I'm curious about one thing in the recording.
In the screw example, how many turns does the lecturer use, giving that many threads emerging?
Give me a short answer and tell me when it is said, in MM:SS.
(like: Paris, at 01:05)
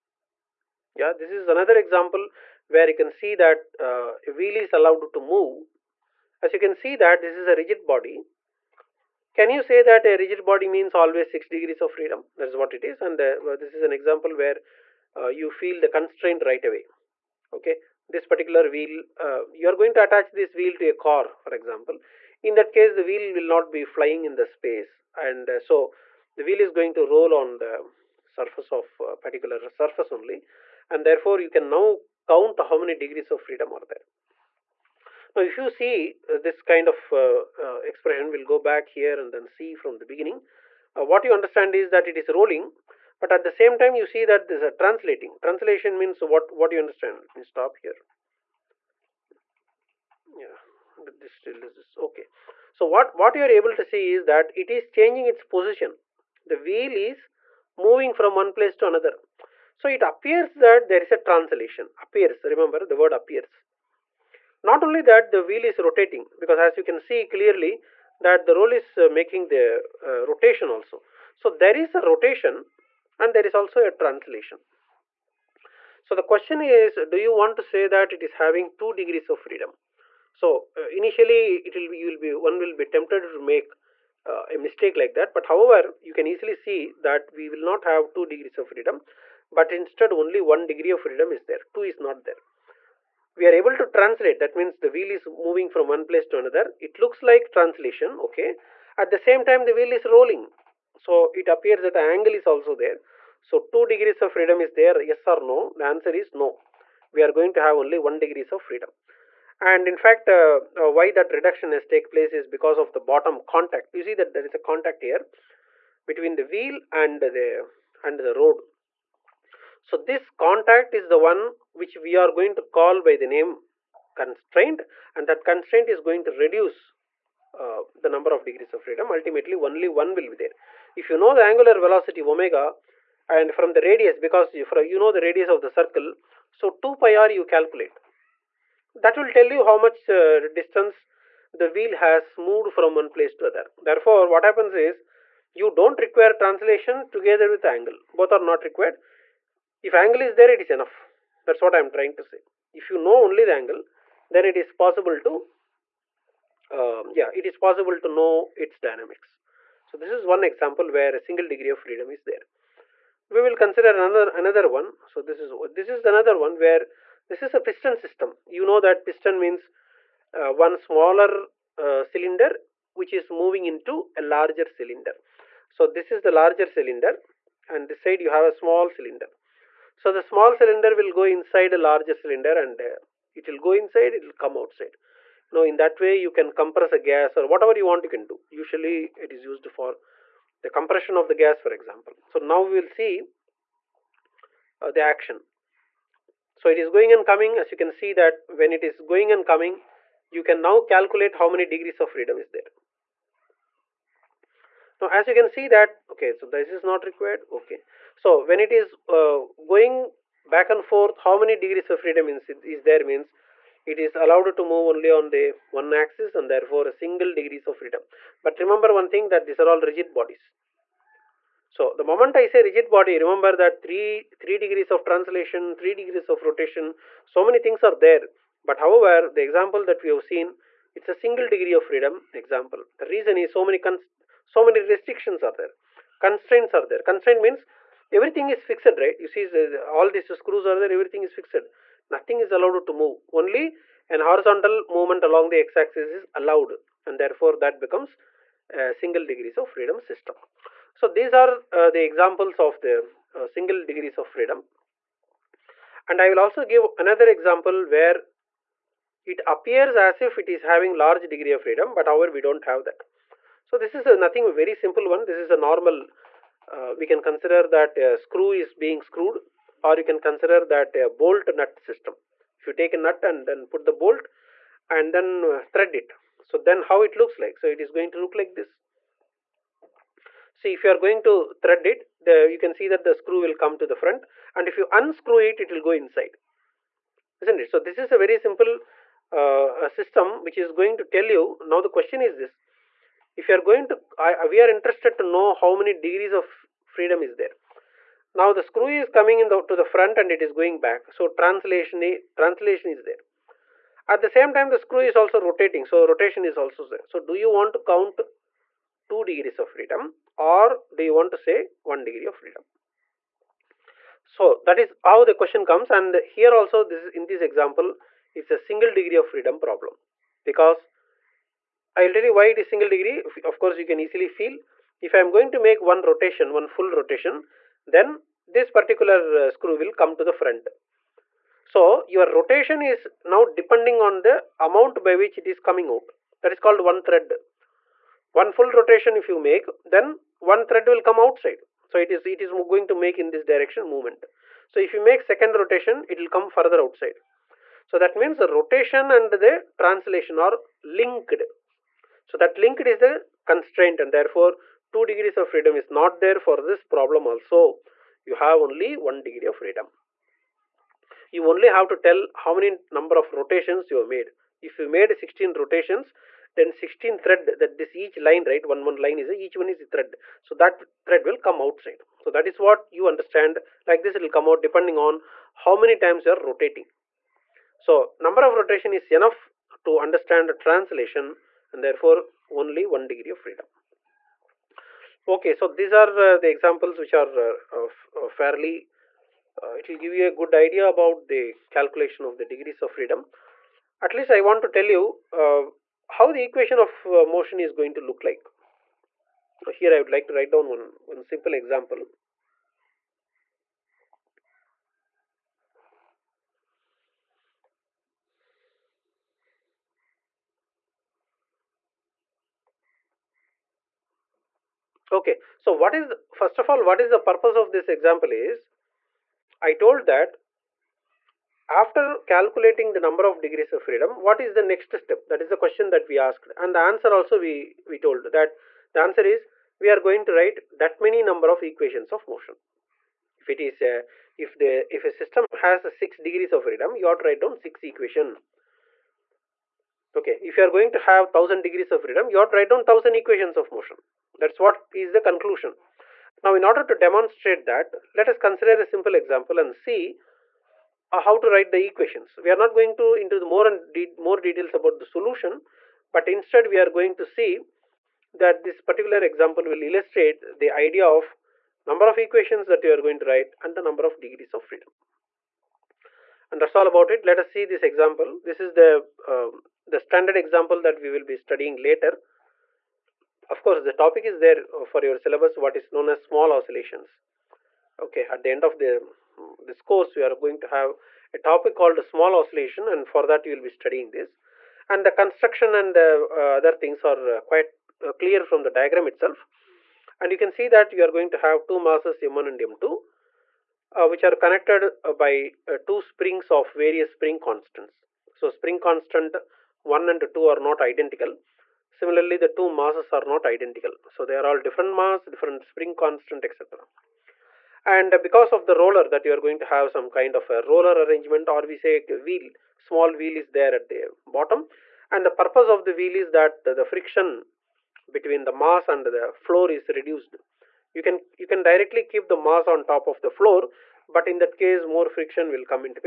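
16, at 06:05.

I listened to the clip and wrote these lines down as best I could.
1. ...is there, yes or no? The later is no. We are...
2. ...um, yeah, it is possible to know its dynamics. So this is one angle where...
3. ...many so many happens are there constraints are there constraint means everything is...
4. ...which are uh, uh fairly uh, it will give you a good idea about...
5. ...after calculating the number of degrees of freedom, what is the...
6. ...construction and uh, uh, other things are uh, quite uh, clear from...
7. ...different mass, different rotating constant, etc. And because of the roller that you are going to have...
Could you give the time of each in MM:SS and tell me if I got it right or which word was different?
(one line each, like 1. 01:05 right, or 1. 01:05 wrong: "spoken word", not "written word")
1. 01:44 wrong: "answer", not "later"
2. 02:36 wrong: "example", not "angle"
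3. 03:53 wrong: "restrictions", not "happens"
4. 06:27 right
5. 07:01 right
6. 08:05 right
7. 08:24 wrong: "spring", not "rotating".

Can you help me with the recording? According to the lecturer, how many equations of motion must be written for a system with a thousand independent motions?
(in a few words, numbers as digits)
1000.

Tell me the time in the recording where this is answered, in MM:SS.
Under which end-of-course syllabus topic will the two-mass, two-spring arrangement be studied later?
07:56.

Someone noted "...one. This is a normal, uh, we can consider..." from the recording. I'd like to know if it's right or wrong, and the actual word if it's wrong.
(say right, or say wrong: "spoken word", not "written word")
right.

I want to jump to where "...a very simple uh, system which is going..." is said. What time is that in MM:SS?
04:48.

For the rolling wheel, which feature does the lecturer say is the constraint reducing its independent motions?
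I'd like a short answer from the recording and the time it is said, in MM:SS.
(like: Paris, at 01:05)
The bottom contact, at 01:52.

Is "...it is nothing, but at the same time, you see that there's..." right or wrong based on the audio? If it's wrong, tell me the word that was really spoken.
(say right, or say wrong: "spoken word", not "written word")
wrong: "rolling", not "nothing".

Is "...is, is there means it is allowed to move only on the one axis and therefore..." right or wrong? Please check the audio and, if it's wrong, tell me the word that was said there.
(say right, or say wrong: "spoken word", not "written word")
right.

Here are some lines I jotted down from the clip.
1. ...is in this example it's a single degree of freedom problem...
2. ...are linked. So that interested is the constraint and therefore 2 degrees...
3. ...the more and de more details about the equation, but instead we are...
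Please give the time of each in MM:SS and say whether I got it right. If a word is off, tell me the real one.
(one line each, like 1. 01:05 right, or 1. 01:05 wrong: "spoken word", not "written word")
1. 05:17 right
2. 05:50 wrong: "linked", not "interested"
3. 07:33 wrong: "solution", not "equation".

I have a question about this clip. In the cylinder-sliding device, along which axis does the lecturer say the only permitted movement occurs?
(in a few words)
The x-axis.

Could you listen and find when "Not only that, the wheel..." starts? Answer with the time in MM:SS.
01:04.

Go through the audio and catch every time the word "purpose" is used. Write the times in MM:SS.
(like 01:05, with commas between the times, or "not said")
06:57, 08:35.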